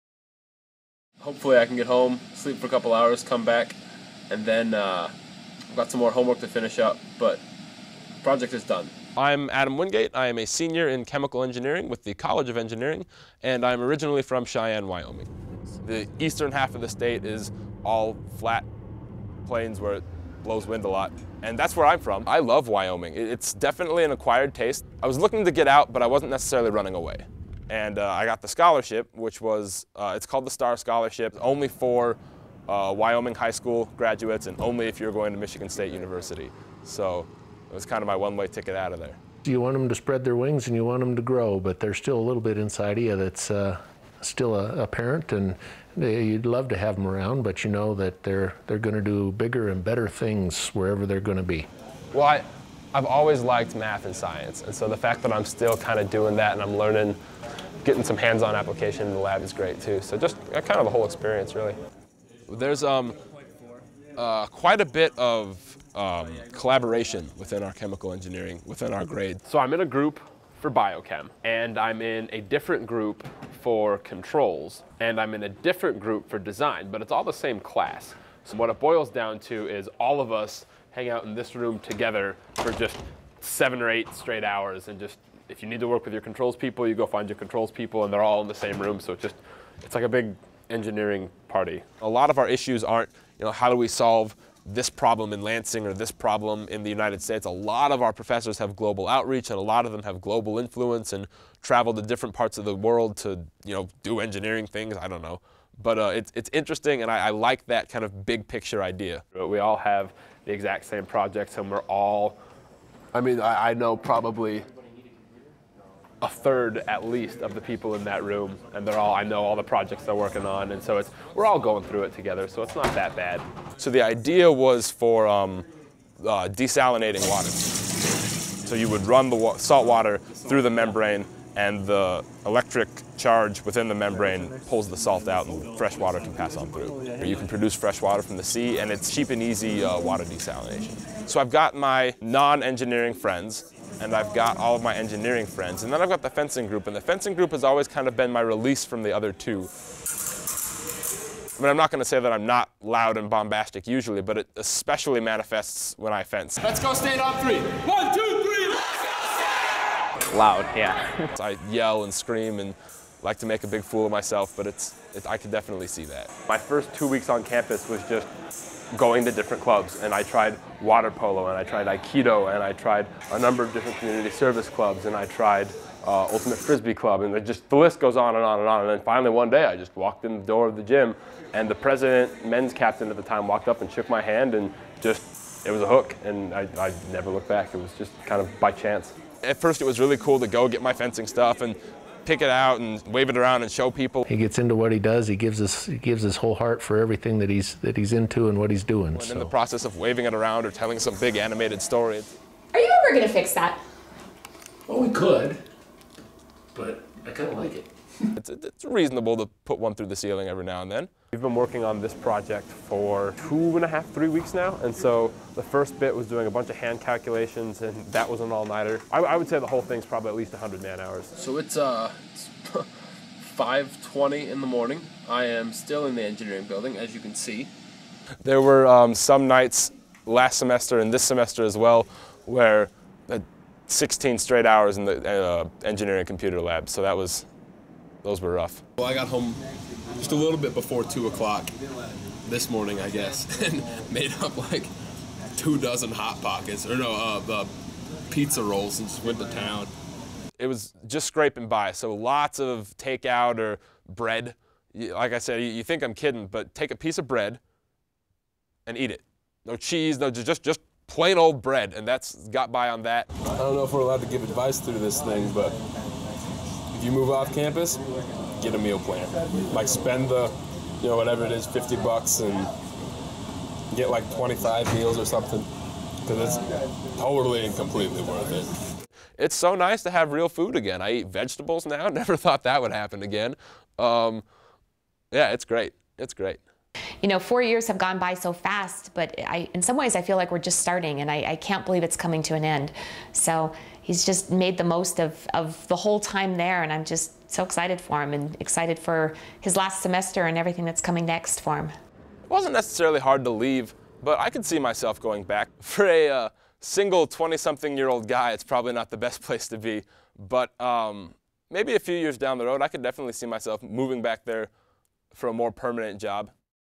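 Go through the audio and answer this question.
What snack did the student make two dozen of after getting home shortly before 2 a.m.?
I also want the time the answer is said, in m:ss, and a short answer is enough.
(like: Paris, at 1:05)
Pizza rolls, at 4:08.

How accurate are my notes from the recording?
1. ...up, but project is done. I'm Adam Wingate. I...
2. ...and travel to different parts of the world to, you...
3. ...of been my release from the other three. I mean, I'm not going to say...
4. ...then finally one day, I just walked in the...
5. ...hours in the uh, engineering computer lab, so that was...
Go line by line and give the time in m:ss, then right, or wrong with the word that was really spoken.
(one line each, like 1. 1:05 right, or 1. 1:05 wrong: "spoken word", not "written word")
1. 0:06 right
2. 1:41 right
3. 2:28 wrong: "two", not "three"
4. 2:58 right
5. 3:54 right.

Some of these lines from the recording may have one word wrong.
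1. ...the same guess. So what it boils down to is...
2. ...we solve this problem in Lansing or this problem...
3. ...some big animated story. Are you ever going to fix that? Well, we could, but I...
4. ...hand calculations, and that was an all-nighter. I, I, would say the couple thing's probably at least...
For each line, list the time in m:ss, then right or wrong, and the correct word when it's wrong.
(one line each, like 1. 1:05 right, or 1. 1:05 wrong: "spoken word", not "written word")
1. 1:17 wrong: "class", not "guess"
2. 1:33 right
3. 3:20 right
4. 3:36 wrong: "whole", not "couple".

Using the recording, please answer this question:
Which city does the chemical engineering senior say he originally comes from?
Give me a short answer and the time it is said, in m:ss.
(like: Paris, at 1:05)
Cheyenne, Wyoming, at 0:14.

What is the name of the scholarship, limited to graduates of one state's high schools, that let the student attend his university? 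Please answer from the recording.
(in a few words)
STAR Scholarship.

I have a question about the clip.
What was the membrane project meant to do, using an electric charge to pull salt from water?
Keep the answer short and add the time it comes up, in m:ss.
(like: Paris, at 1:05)
Desalinating water, at 2:06.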